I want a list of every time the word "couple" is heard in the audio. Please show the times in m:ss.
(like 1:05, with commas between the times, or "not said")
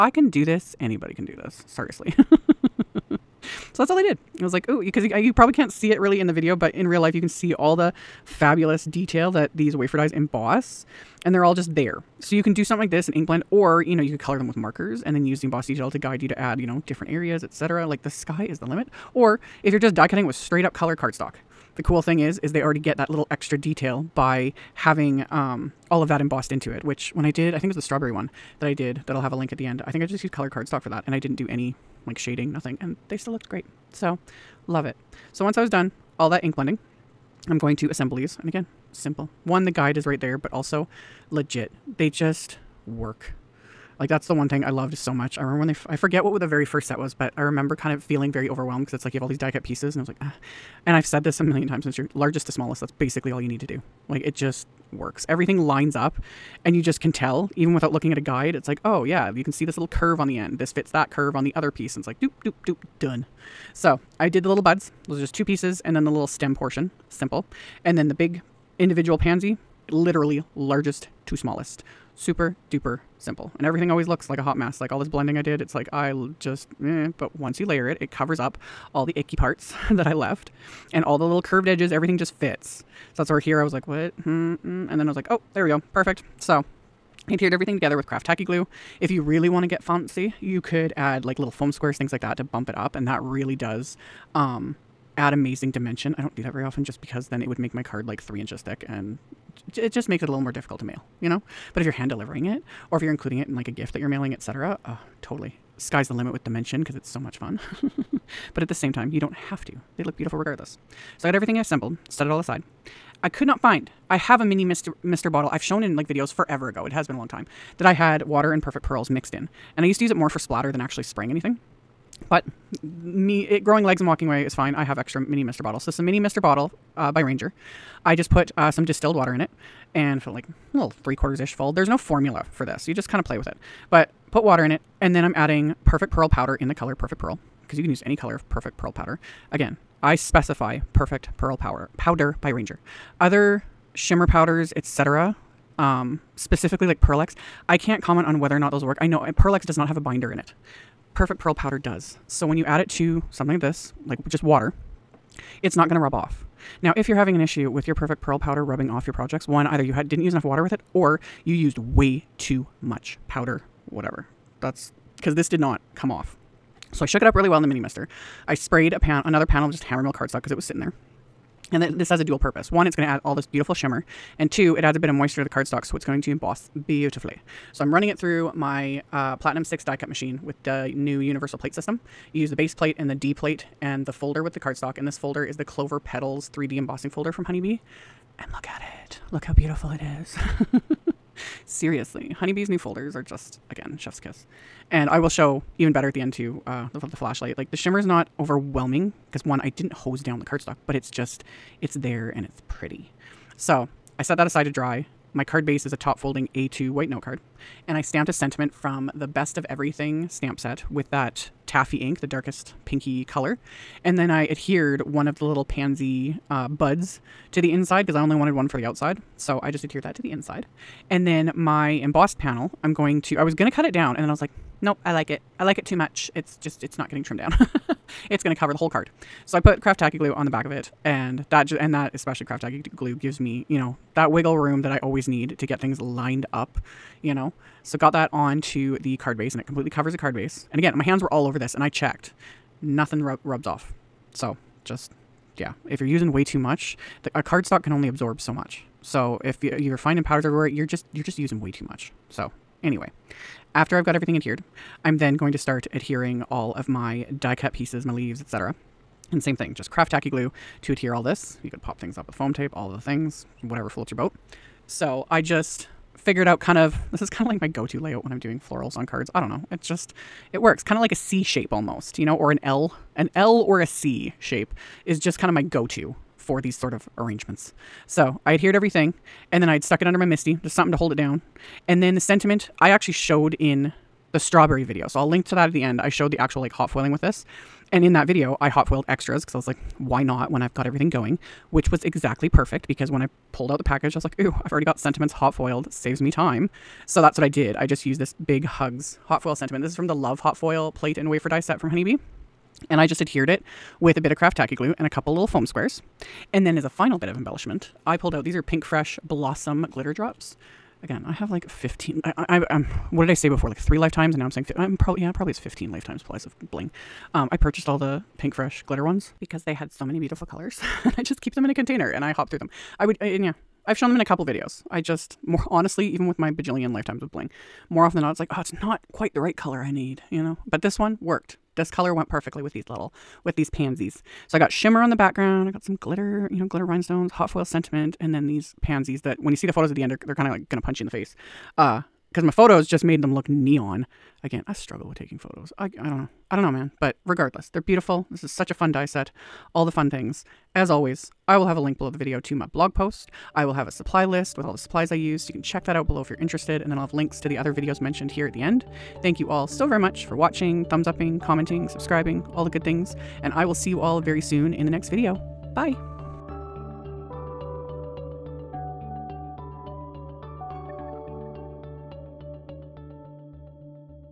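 5:05, 5:24.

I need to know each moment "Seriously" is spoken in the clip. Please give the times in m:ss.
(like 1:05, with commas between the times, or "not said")
0:01, 3:11.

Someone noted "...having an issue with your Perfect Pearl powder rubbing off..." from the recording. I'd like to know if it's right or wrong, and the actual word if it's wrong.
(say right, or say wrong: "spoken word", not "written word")
right.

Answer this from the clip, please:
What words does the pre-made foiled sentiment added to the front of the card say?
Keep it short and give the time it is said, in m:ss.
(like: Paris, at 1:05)
Big hugs, at 4:58.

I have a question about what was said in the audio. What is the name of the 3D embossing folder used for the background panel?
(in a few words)
Clover Petals.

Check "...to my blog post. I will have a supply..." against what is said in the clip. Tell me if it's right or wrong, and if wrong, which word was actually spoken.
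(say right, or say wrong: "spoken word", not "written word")
right.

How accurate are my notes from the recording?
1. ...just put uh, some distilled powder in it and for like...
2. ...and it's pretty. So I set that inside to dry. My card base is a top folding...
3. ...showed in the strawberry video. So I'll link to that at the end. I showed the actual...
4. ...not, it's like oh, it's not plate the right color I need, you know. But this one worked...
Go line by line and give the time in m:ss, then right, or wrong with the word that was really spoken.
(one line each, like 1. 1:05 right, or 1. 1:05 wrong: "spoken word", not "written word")
1. 2:08 wrong: "water", not "powder"
2. 3:22 wrong: "aside", not "inside"
3. 4:43 right
4. 5:28 wrong: "quite", not "plate".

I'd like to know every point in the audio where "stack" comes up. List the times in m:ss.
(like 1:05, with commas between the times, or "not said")
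not said.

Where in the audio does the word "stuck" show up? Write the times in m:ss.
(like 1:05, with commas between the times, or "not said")
4:39.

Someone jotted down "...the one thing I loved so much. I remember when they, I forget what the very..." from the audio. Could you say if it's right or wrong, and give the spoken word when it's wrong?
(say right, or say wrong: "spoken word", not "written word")
right.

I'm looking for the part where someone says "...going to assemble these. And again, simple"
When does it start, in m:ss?
0:37.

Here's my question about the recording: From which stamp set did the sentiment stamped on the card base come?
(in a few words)
Best of Everything.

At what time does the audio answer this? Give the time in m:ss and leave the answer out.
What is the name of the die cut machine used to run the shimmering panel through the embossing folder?
2:59.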